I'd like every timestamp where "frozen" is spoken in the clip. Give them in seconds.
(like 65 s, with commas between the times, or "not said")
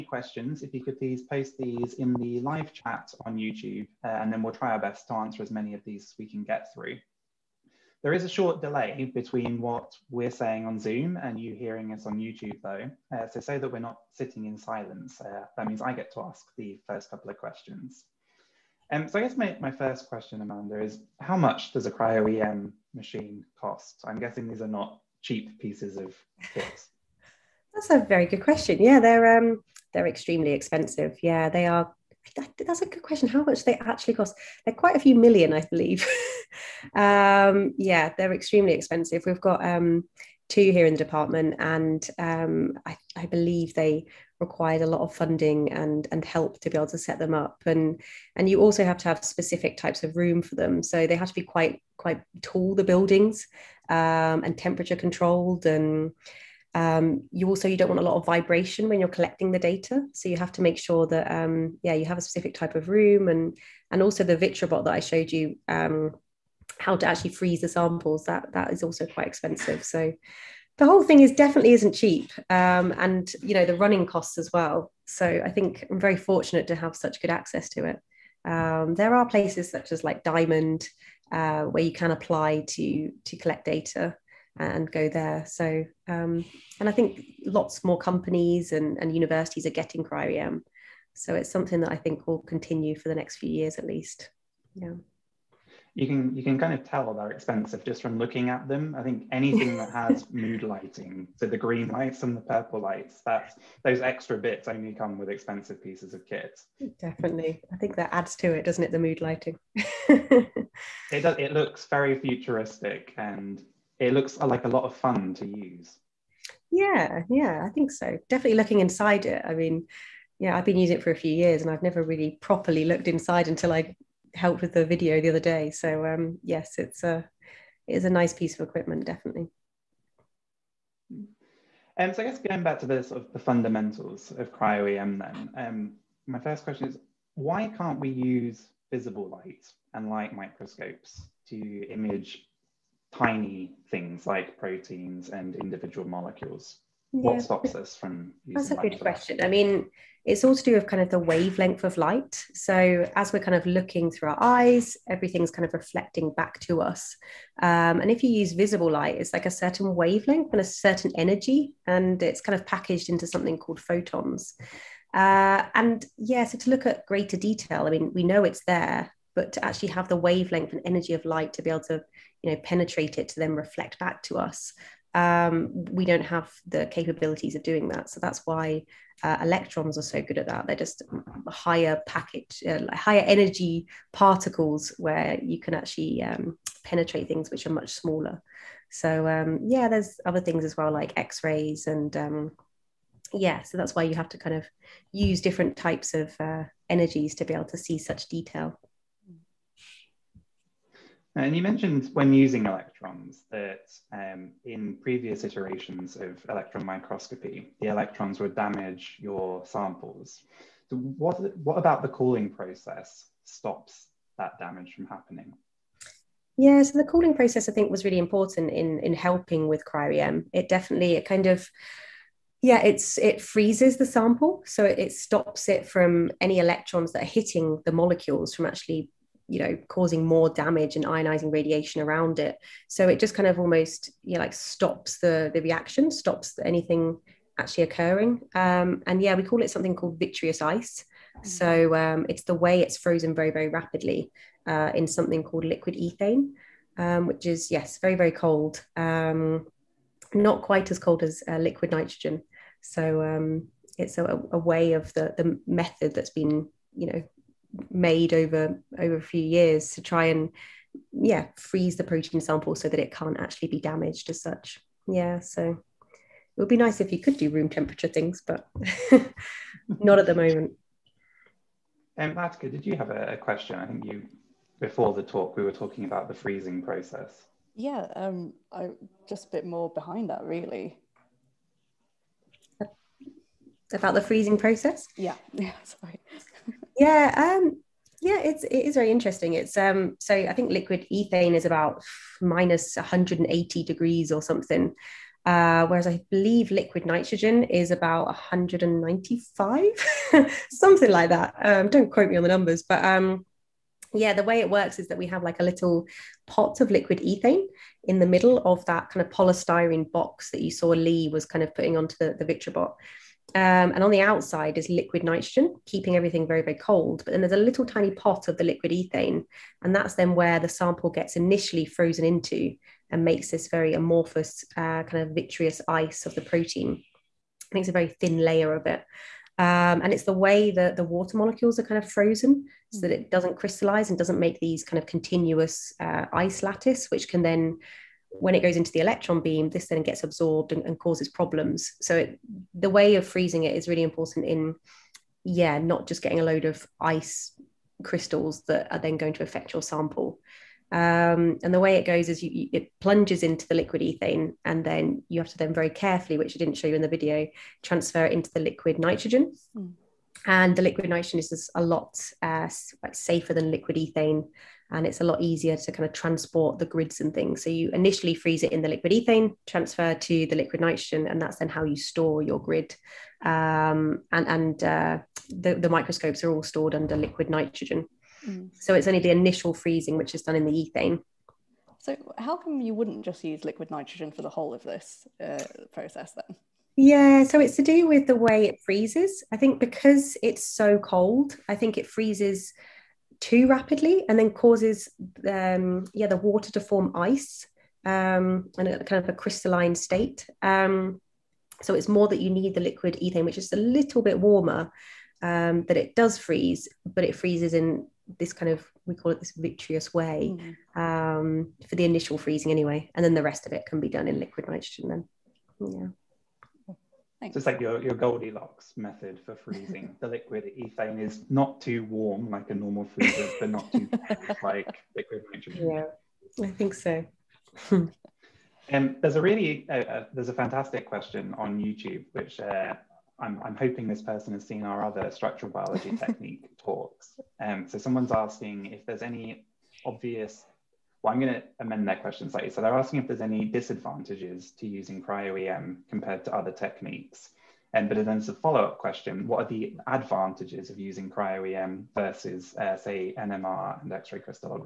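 242 s, 321 s, 332 s.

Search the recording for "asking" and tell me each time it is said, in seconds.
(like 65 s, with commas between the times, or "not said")
438 s, 442 s.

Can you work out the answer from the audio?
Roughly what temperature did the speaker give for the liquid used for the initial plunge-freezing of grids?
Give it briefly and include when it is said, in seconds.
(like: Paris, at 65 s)
minus 180 degrees, at 292 s.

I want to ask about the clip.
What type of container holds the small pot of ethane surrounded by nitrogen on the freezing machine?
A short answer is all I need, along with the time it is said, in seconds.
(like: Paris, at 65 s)
polystyrene box, at 309 s.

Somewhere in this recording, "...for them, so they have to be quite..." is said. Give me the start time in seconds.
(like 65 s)
50 s.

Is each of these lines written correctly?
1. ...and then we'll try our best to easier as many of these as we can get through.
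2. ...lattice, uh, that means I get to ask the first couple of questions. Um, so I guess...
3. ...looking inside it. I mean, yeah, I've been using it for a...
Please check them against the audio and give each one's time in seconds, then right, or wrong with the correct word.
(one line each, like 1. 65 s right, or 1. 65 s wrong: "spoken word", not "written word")
1. 4 s wrong: "answer", not "easier"
2. 14 s wrong: "silence", not "lattice"
3. 118 s right.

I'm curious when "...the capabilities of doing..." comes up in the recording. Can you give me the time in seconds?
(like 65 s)
176 s.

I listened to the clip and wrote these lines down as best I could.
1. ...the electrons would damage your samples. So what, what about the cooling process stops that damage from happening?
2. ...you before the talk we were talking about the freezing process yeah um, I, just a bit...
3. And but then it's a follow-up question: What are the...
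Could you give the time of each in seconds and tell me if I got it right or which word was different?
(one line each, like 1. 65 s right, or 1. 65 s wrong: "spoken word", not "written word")
1. 207 s right
2. 274 s right
3. 447 s right.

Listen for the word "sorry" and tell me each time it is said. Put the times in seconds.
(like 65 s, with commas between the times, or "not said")
285 s.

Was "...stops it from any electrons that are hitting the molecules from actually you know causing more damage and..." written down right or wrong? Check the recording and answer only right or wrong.
right.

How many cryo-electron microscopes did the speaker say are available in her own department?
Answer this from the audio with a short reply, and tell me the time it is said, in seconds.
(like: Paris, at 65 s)
2, at 40 s.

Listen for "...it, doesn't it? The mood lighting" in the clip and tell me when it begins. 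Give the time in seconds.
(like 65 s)
108 s.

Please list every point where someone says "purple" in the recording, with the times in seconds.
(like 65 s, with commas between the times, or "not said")
102 s.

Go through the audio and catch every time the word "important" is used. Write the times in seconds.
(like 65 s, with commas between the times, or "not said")
218 s, 344 s.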